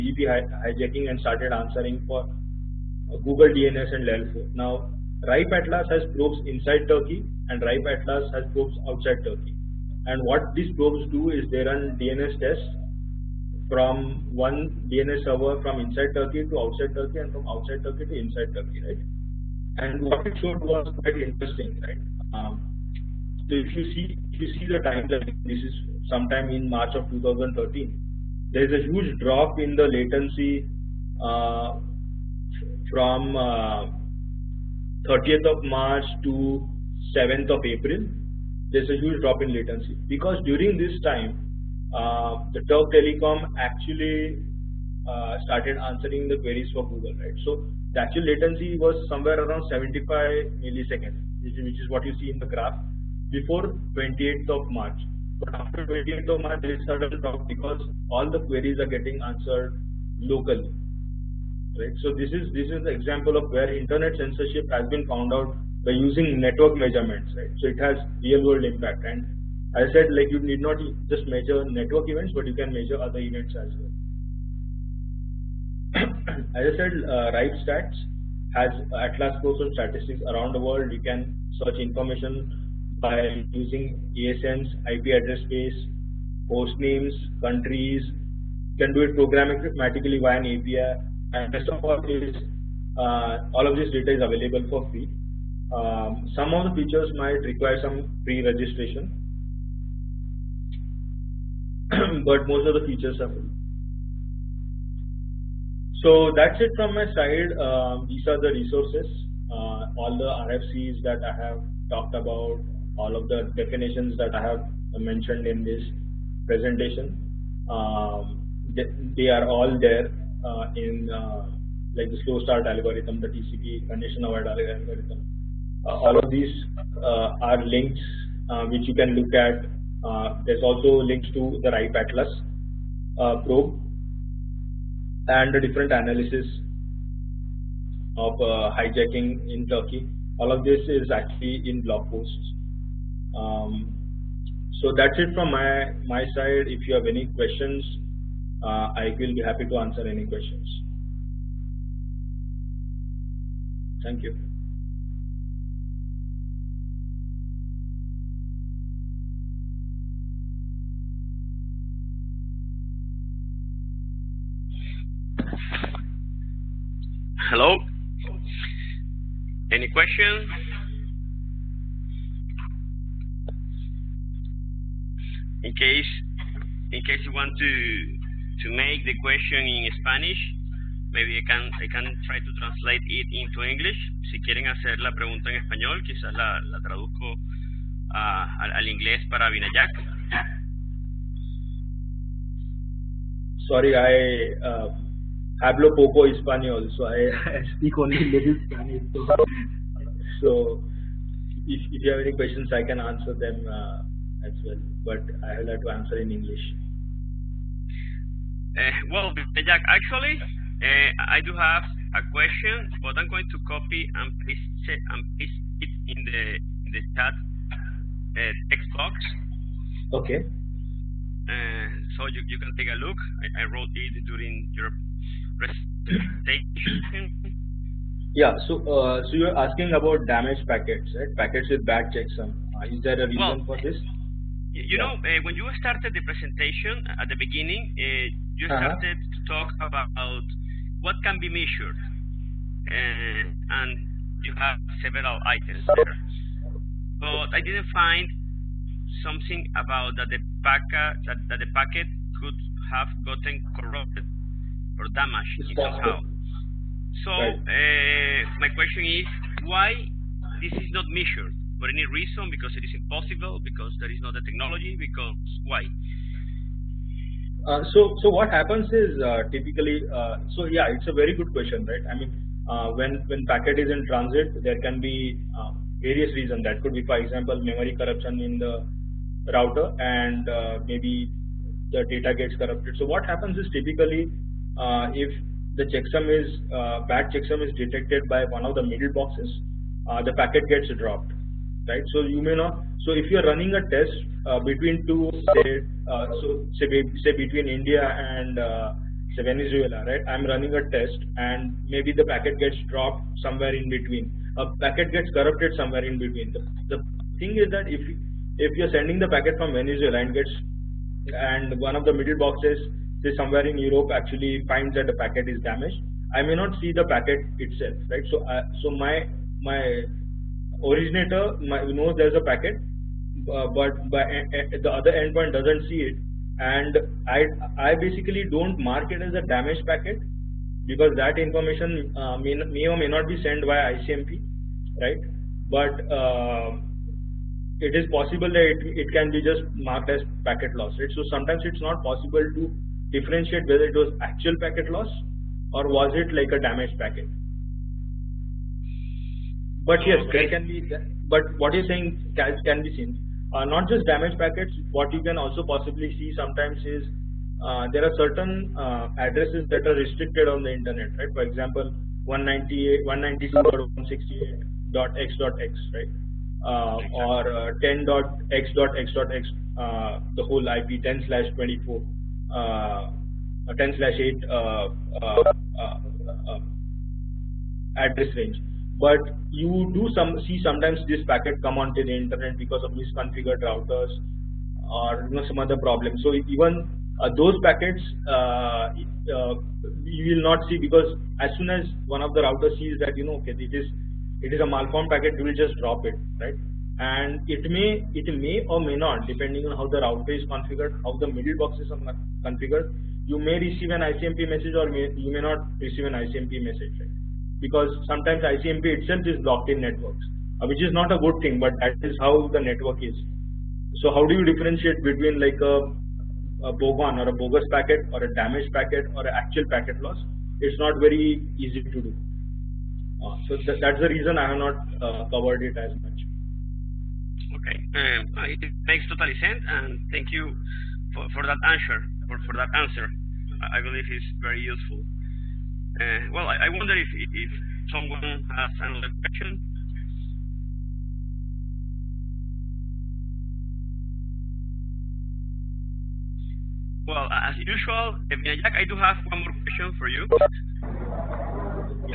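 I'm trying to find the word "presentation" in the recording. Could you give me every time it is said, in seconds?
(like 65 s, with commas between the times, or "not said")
116 s, 236 s.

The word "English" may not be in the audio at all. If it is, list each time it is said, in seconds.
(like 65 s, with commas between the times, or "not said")
183 s, 206 s.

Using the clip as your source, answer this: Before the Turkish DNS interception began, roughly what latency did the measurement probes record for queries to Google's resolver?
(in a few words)
75 milliseconds.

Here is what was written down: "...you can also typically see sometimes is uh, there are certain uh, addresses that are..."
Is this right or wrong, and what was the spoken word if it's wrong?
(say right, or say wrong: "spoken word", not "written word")
wrong: "possibly", not "typically".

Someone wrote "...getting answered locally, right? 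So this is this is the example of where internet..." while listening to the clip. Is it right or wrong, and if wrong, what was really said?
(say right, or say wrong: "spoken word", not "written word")
right.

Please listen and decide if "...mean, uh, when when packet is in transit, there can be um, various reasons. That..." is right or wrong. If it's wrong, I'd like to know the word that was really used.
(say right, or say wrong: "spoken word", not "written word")
right.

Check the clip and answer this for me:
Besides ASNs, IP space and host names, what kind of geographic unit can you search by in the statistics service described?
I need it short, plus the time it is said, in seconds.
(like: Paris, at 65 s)
countries, at 87 s.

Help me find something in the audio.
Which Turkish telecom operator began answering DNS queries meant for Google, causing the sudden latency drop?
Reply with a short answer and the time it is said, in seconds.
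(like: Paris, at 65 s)
Turk Telecom, at 42 s.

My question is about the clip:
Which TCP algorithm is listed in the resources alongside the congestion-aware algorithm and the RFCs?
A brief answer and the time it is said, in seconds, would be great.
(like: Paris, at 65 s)
slow start algorithm, at 122 s.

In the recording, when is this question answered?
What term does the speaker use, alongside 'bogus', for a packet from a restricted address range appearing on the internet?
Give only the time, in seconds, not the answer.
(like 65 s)
416 s.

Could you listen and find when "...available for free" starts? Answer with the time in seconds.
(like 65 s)
94 s.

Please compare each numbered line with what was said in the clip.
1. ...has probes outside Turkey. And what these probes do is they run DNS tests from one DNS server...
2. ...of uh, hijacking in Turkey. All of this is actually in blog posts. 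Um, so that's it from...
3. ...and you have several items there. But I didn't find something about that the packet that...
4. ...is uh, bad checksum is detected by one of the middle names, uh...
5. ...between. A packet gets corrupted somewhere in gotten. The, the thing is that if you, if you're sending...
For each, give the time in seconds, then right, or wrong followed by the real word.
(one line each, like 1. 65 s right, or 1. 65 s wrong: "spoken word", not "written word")
1. 8 s right
2. 138 s right
3. 243 s right
4. 286 s wrong: "boxes", not "names"
5. 303 s wrong: "between", not "gotten".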